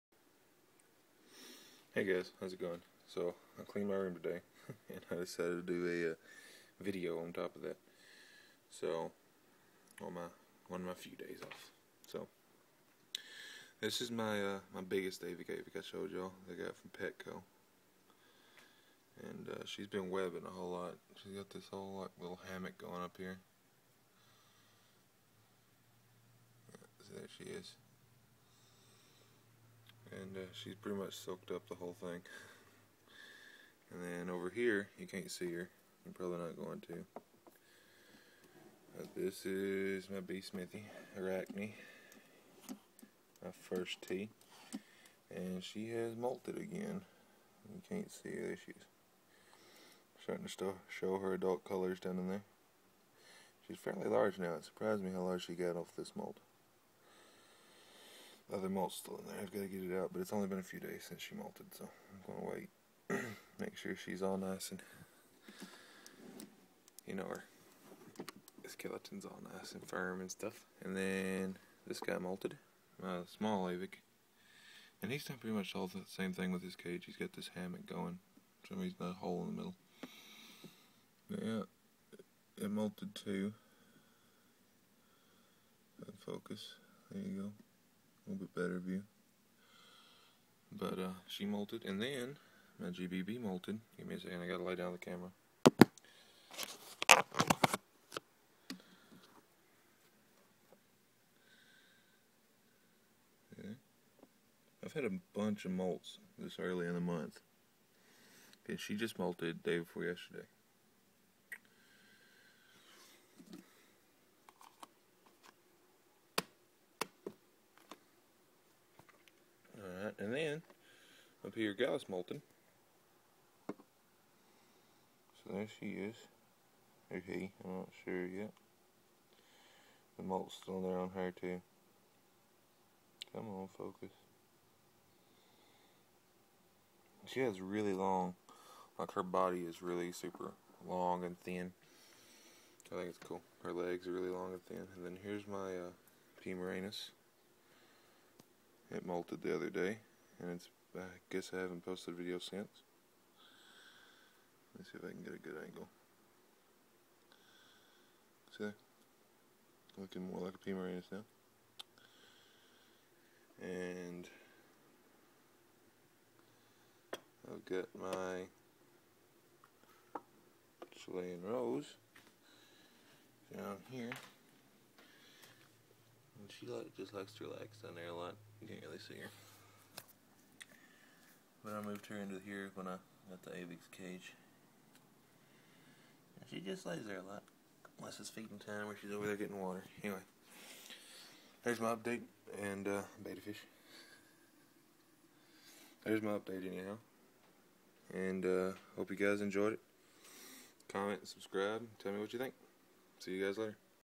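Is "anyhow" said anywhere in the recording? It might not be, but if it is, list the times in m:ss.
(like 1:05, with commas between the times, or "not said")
3:16.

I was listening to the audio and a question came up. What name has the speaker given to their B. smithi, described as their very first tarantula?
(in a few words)
Arachne.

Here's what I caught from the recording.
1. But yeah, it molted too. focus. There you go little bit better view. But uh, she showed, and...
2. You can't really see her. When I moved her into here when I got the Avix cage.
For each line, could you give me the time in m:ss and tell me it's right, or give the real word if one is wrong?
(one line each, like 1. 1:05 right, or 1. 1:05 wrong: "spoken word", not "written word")
1. 1:21 wrong: "molted", not "showed"
2. 2:58 right.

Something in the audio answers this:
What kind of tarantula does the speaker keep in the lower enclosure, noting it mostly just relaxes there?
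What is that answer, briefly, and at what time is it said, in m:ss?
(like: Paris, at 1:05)
Chilean rose, at 2:50.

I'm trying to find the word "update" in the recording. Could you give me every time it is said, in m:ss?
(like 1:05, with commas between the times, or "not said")
3:11, 3:16.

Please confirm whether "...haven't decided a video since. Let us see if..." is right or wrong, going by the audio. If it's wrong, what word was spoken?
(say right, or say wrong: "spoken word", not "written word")
wrong: "posted", not "decided".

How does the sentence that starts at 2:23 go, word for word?
Her legs are really long and thin.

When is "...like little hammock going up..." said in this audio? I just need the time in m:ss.
0:21.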